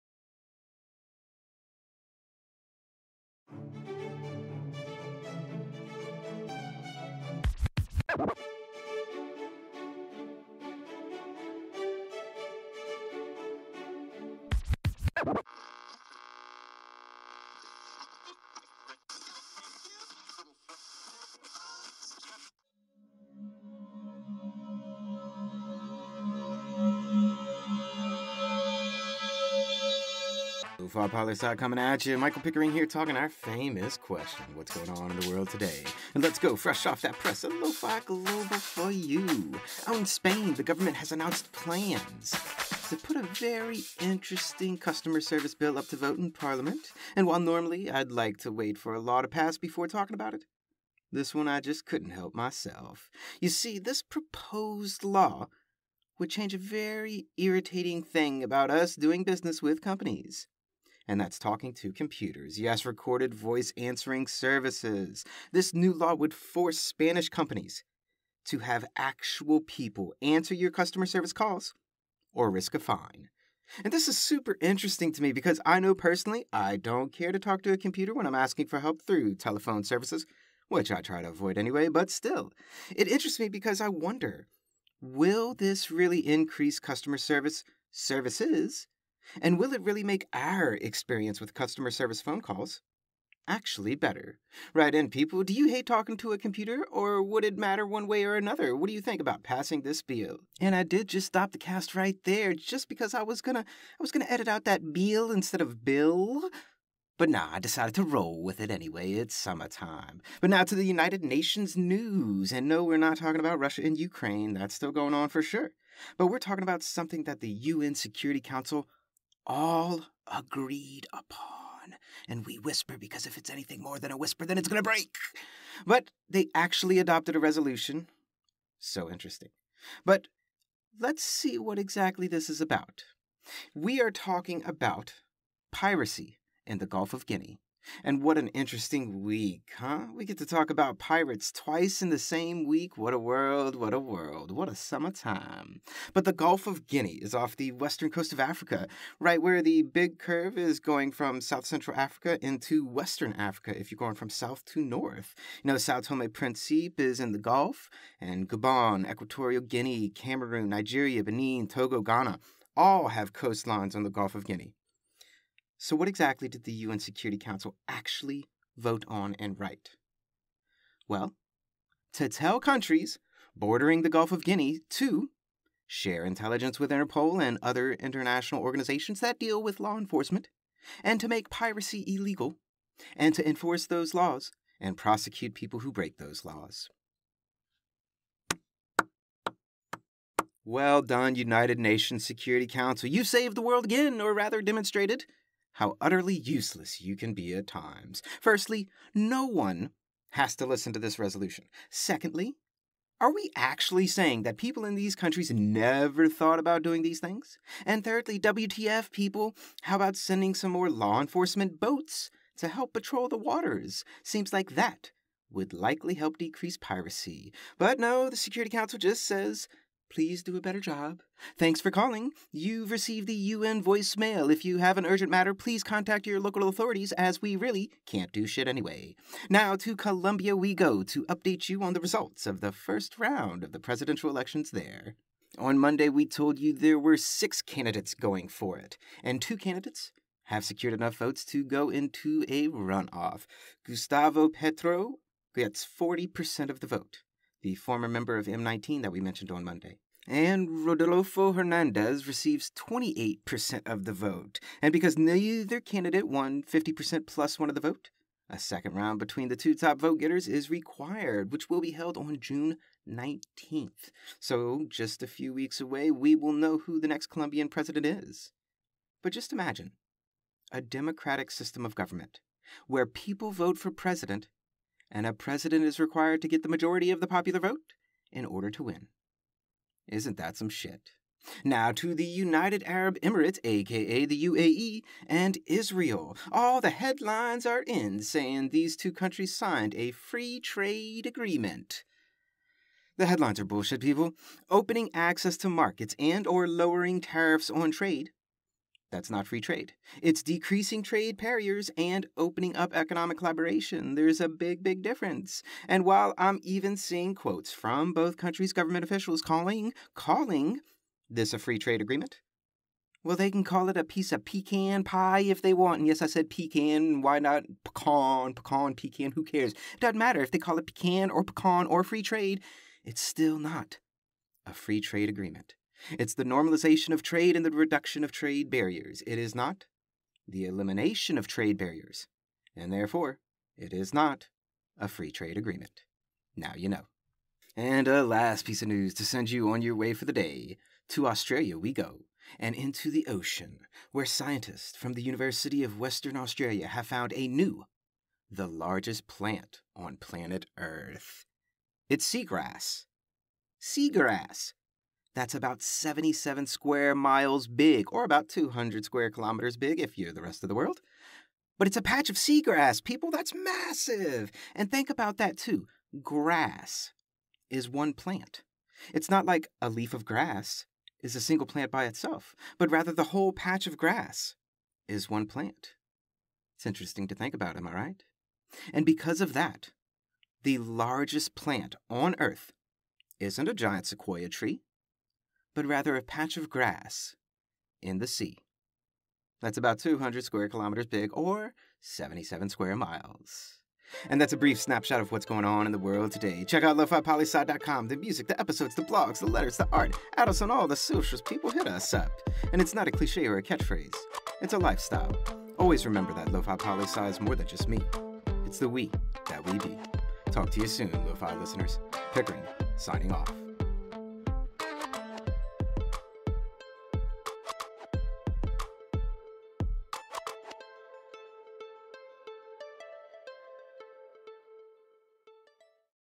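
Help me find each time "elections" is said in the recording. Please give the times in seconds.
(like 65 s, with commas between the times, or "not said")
234 s.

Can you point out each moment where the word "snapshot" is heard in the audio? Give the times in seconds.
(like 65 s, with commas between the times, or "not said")
394 s.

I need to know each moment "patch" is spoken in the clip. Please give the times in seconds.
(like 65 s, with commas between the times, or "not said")
362 s, 373 s, 386 s.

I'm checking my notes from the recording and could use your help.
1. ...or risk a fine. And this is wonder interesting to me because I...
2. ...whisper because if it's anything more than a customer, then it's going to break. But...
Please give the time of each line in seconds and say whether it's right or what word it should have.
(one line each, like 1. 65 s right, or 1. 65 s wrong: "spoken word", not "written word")
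1. 72 s wrong: "super", not "wonder"
2. 122 s wrong: "whisper", not "customer".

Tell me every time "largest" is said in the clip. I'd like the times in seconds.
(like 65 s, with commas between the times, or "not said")
348 s, 380 s.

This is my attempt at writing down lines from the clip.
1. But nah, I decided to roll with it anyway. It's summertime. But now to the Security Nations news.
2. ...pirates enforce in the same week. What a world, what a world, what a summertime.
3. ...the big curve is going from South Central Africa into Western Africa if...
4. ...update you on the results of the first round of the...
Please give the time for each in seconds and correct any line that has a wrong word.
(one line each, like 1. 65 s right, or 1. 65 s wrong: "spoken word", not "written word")
1. 107 s wrong: "United", not "Security"
2. 140 s wrong: "twice", not "enforce"
3. 149 s right
4. 231 s right.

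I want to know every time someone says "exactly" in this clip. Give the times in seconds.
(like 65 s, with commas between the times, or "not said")
131 s, 166 s.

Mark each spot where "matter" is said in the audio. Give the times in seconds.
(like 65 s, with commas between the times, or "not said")
97 s, 225 s, 320 s.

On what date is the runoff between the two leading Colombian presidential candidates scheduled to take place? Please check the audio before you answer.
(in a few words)
June 19th.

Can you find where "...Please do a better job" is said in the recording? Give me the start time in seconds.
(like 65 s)
220 s.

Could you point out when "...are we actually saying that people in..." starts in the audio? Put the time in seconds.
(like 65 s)
203 s.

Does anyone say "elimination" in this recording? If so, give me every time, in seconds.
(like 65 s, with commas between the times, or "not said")
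330 s.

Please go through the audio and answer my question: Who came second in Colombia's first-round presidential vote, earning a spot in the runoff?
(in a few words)
Rodolfo Hernandez.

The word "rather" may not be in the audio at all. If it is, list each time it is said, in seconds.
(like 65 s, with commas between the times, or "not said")
194 s, 372 s, 385 s.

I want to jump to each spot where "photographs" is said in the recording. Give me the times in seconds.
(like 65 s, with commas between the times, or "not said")
not said.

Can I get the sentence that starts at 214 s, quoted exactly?
Seems like that would likely help decrease piracy.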